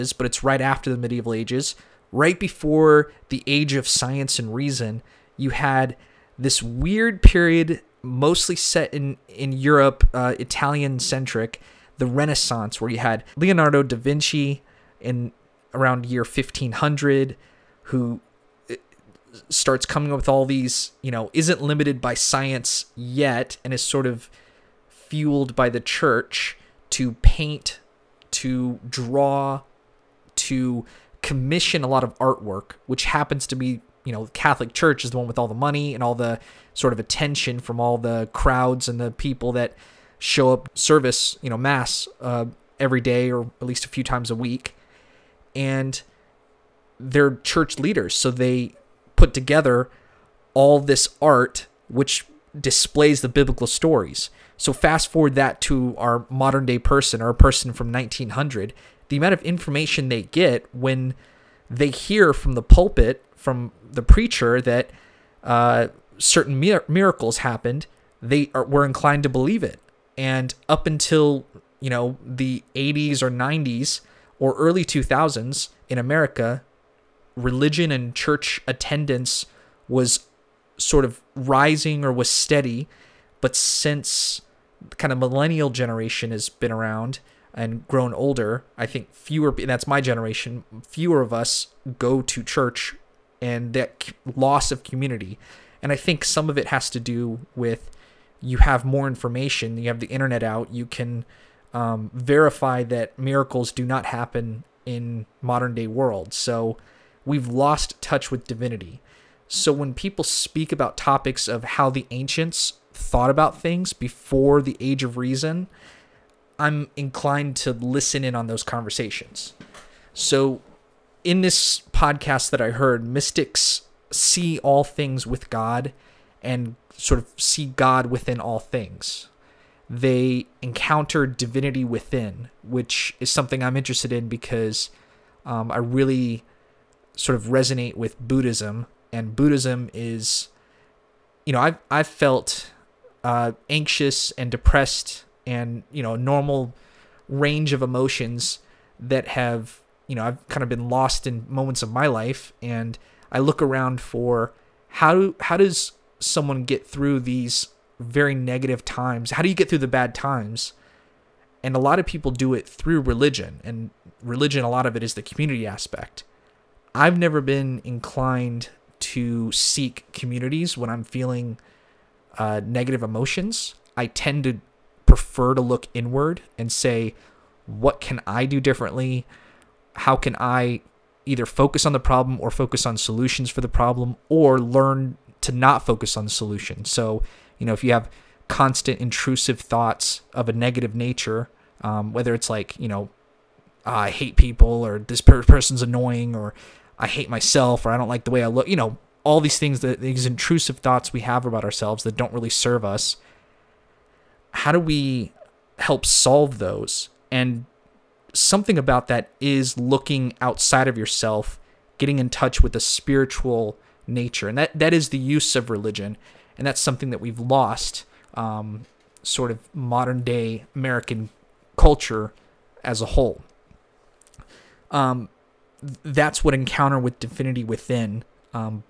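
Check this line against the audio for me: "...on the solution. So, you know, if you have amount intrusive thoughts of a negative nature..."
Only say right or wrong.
wrong.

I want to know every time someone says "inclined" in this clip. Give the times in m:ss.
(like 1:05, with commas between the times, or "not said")
1:08, 1:56, 2:47.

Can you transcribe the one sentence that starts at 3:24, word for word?
How do we help solve those and something about that is looking outside of yourself, getting in touch with a spiritual nature.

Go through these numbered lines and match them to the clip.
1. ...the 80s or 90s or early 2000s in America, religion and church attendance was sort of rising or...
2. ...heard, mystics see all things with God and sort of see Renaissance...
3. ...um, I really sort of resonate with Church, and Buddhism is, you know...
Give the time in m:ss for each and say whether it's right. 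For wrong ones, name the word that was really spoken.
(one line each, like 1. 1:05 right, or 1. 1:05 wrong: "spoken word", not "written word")
1. 1:12 right
2. 2:02 wrong: "God", not "Renaissance"
3. 2:15 wrong: "Buddhism", not "Church".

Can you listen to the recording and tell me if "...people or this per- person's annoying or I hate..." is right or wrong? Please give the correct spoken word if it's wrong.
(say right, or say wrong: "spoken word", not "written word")
right.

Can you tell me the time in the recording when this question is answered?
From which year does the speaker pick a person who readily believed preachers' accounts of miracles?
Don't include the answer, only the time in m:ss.
0:57.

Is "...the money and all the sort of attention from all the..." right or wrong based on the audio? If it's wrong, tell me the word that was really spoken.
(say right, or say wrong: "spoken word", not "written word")
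right.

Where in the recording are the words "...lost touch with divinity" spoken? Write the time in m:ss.
1:47.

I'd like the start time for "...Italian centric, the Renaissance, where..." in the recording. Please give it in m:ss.
0:10.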